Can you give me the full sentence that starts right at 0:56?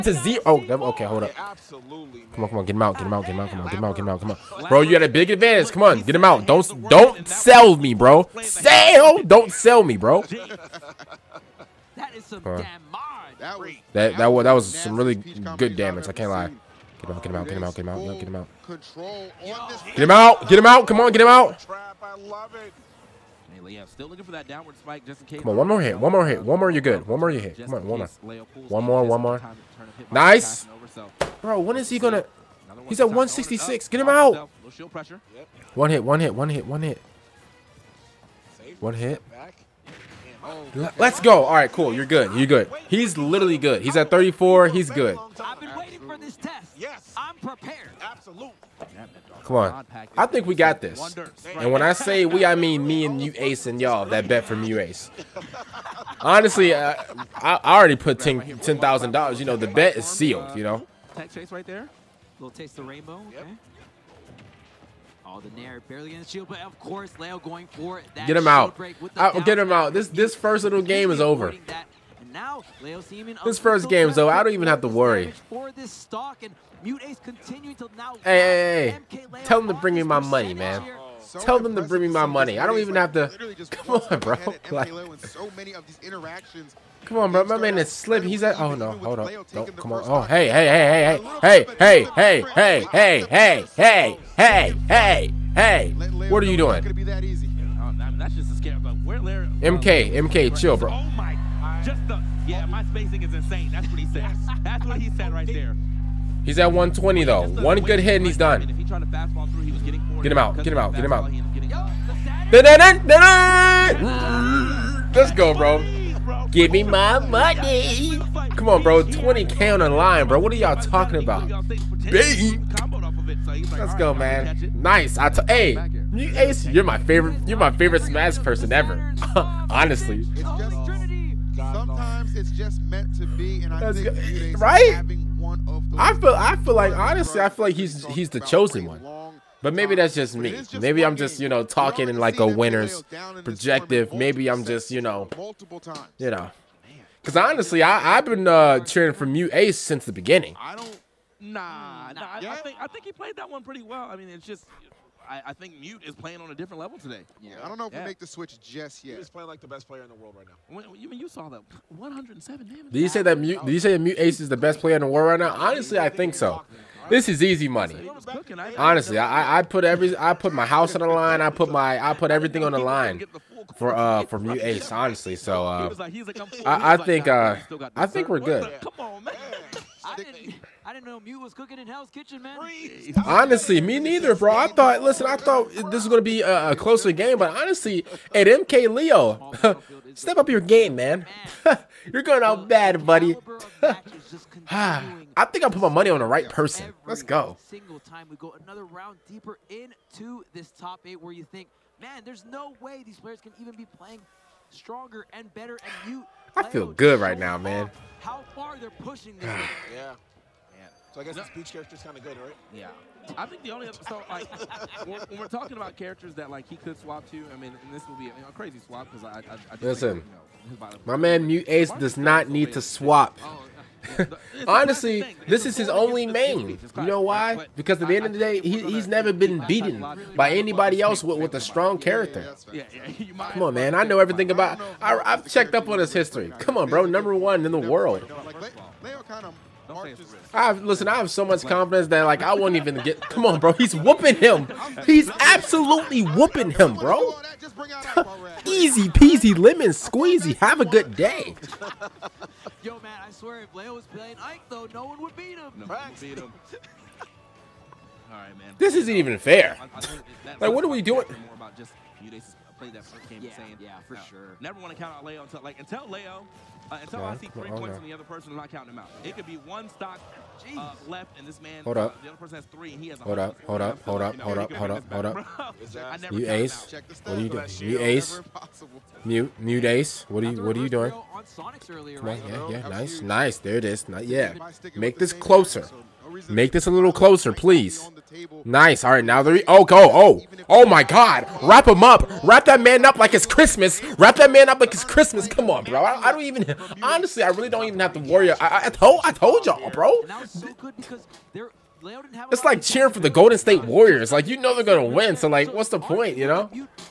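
Honestly, uh, I, I already put $10,000.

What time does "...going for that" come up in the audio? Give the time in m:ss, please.
1:07.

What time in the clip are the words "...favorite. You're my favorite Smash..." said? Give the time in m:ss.
2:06.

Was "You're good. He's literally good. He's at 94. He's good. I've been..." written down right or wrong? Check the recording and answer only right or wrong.
wrong.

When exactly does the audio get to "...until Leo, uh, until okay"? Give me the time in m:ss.
4:25.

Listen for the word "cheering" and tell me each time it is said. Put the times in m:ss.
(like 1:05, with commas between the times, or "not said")
2:28, 5:02.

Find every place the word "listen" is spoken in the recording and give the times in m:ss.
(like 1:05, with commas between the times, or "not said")
3:05, 3:39, 4:00.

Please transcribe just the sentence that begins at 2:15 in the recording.
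I feel, I feel like honestly, I feel like he's he's the chosen one.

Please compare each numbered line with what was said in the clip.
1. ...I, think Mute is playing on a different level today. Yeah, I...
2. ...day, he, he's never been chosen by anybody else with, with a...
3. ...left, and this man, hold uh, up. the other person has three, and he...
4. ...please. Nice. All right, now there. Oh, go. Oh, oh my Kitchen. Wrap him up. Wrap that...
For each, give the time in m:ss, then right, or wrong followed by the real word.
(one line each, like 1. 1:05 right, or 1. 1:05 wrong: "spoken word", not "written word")
1. 2:35 right
2. 3:48 wrong: "beaten", not "chosen"
3. 4:31 right
4. 4:47 wrong: "God", not "Kitchen".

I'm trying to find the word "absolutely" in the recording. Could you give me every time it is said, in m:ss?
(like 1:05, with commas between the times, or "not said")
0:48, 4:05.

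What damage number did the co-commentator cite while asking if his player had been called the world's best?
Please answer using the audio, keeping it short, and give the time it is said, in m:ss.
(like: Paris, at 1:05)
107, at 2:41.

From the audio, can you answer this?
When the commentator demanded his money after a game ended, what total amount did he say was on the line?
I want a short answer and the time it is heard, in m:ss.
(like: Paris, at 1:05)
20K, at 1:59.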